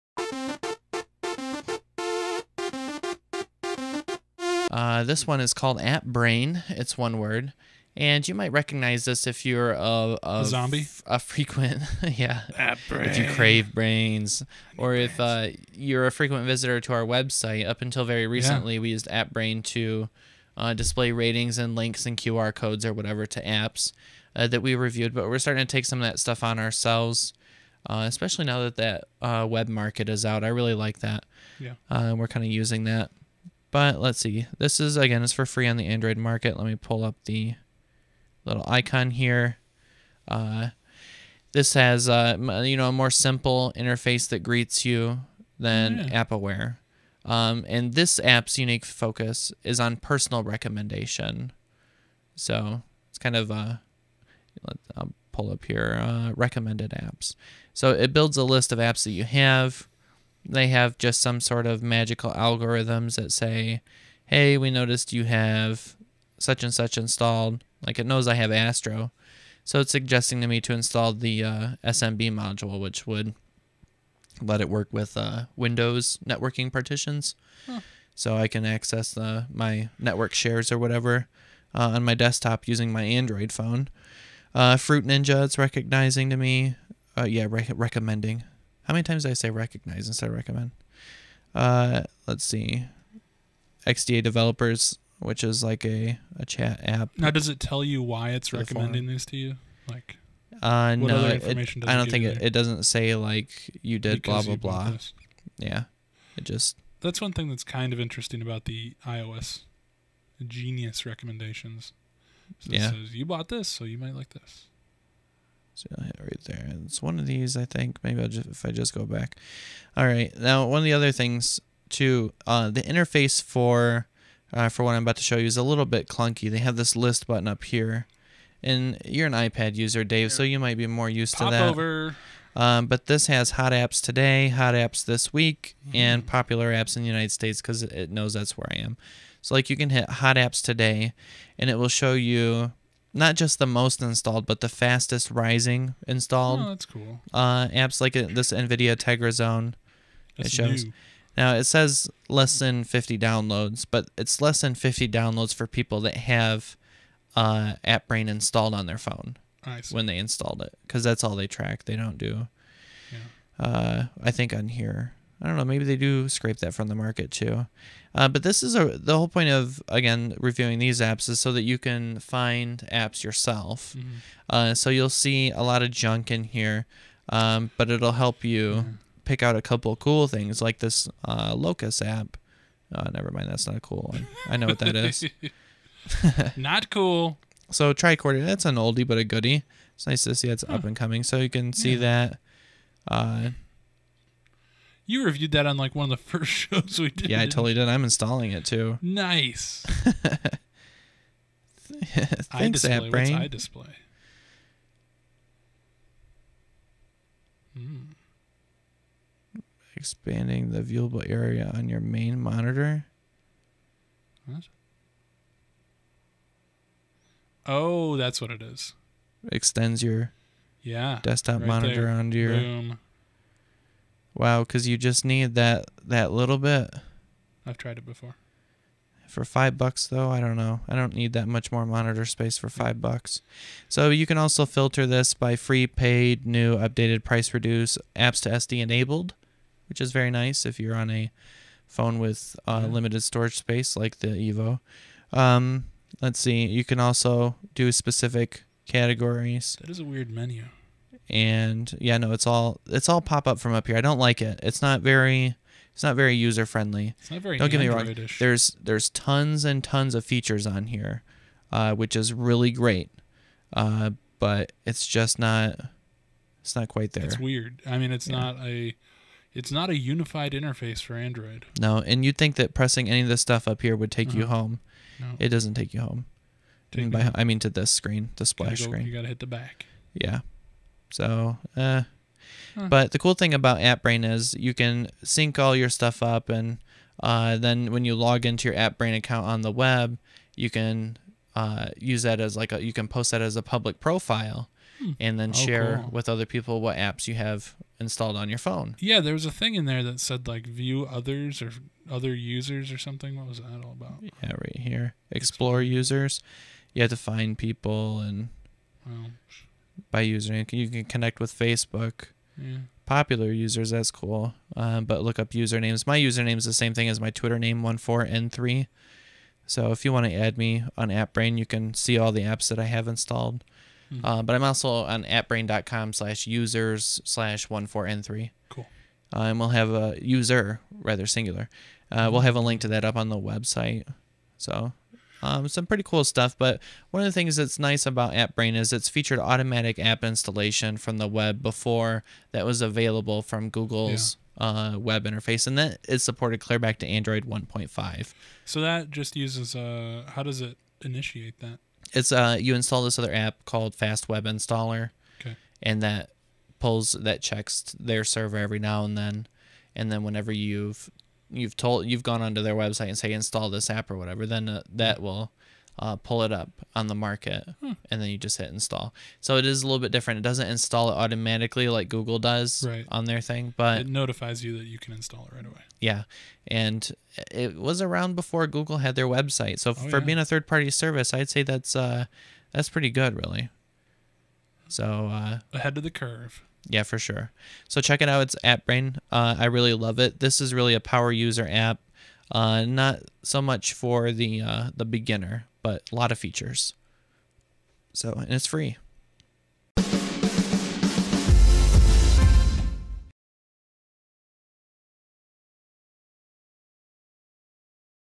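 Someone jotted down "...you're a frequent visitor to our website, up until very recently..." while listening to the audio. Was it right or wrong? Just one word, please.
right.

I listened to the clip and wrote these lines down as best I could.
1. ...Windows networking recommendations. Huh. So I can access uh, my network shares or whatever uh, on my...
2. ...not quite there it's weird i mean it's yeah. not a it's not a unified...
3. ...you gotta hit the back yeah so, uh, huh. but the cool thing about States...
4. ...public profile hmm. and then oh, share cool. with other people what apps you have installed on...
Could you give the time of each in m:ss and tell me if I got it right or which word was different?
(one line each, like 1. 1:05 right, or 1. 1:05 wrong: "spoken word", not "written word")
1. 1:15 wrong: "partitions", not "recommendations"
2. 4:26 right
3. 4:39 wrong: "AppBrain", not "States"
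4. 4:53 right.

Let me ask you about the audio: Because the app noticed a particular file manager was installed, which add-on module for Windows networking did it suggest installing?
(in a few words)
SMB module.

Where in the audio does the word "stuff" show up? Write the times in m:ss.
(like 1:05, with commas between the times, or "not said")
0:26, 4:33, 4:45, 5:36.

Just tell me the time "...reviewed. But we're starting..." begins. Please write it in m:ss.
0:24.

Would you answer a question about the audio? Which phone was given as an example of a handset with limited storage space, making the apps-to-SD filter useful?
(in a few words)
Evo.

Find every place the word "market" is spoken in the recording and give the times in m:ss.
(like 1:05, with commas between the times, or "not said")
0:29, 0:36, 2:46, 6:07.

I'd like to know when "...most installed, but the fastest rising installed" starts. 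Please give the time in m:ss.
2:23.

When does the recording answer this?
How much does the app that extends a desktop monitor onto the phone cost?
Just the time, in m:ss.
3:49.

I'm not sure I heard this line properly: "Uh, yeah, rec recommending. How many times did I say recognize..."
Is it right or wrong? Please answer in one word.
right.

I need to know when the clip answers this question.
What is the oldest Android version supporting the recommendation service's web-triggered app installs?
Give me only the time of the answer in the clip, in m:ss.
5:47.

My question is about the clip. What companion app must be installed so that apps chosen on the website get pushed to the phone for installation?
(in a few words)
Fast Web Installer.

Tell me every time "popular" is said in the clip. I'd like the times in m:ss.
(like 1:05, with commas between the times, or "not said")
2:16, 5:13.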